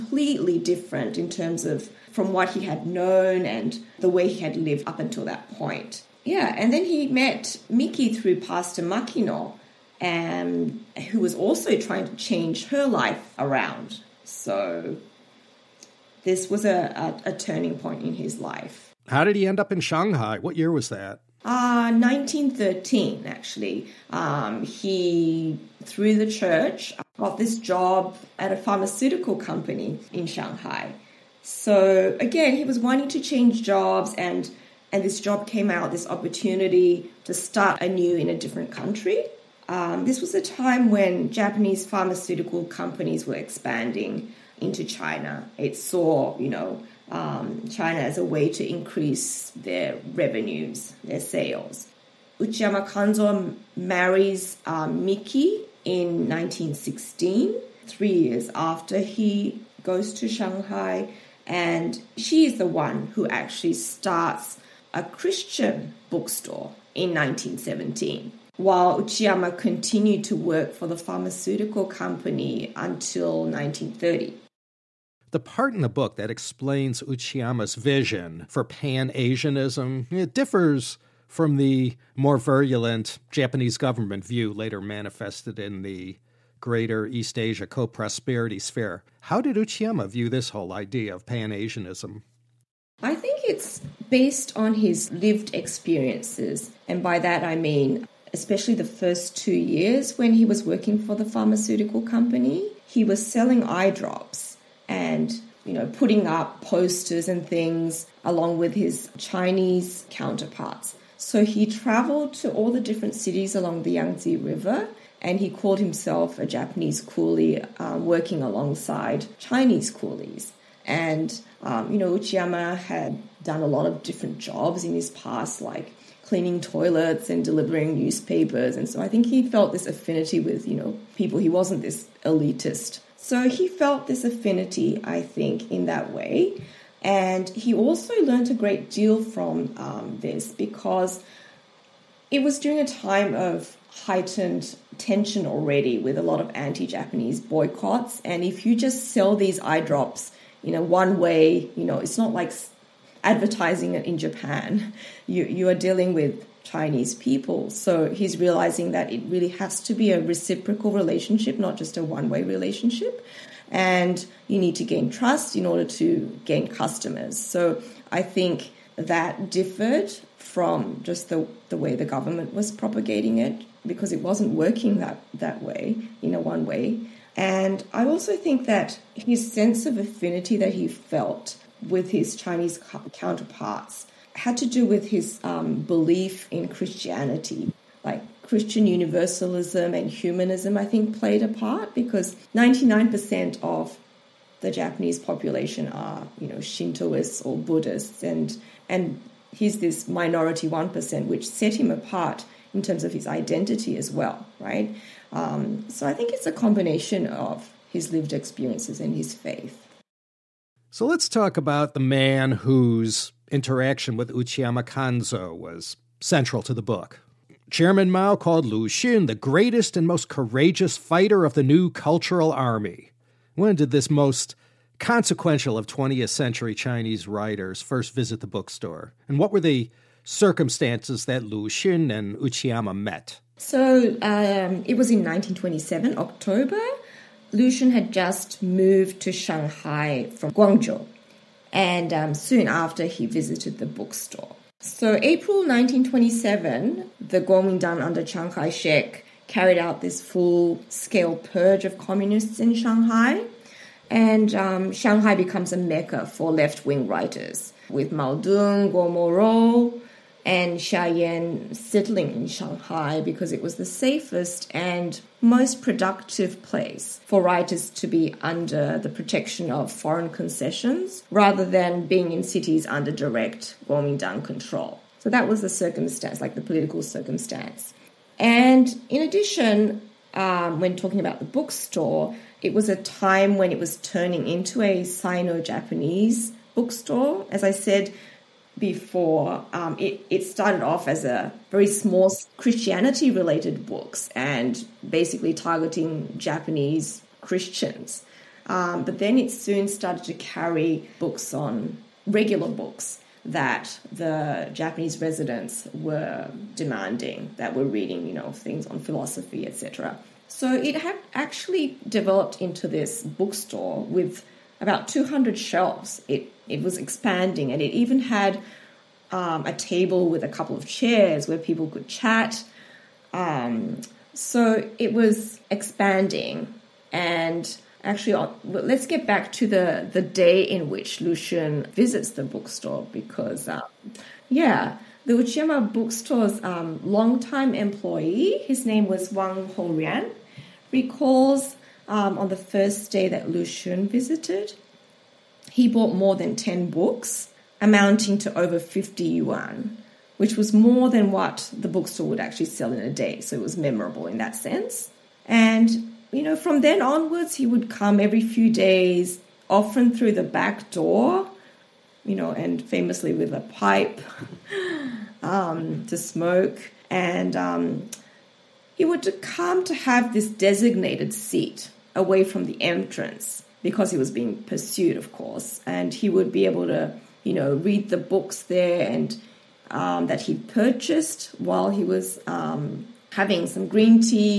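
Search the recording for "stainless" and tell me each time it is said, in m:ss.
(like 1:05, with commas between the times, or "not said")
not said.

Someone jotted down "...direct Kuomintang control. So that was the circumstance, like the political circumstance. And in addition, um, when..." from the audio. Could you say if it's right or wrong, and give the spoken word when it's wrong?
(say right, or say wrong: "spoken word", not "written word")
right.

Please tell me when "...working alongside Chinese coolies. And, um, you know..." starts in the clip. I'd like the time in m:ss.
1:58.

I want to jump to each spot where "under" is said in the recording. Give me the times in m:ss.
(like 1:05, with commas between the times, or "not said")
4:08, 4:28, 4:32.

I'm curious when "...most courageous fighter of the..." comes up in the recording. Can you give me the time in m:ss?
3:40.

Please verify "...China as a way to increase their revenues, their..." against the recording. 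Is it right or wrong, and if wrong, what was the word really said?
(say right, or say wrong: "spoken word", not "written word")
right.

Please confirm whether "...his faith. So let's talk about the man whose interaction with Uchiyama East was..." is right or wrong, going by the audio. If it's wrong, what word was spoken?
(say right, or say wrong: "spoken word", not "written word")
wrong: "Kanzo", not "East".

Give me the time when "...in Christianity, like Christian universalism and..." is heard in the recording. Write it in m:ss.
3:06.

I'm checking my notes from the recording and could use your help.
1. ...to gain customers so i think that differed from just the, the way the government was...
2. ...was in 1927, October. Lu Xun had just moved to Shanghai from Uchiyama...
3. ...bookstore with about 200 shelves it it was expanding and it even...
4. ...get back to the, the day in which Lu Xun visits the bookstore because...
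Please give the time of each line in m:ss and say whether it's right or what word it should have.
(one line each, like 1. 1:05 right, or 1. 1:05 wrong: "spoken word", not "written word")
1. 2:45 right
2. 3:54 wrong: "Guangzhou", not "Uchiyama"
3. 5:13 right
4. 5:29 right.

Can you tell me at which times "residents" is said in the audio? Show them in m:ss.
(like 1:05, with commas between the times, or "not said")
5:05.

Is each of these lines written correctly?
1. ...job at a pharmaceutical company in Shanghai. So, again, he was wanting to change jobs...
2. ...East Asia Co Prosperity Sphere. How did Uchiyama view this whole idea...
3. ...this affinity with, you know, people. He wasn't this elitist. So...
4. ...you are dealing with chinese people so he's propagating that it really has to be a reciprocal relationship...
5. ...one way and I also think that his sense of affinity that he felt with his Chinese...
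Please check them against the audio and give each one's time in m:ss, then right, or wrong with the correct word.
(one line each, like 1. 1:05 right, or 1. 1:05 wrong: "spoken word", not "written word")
1. 0:27 right
2. 1:27 right
3. 2:09 right
4. 2:35 wrong: "realizing", not "propagating"
5. 2:56 right.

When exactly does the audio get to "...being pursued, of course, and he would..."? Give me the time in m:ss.
6:14.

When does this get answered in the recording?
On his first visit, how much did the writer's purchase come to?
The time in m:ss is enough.
5:48.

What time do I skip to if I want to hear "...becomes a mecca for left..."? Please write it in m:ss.
4:15.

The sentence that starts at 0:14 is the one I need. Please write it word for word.
So this was a, a, a turning point in his life.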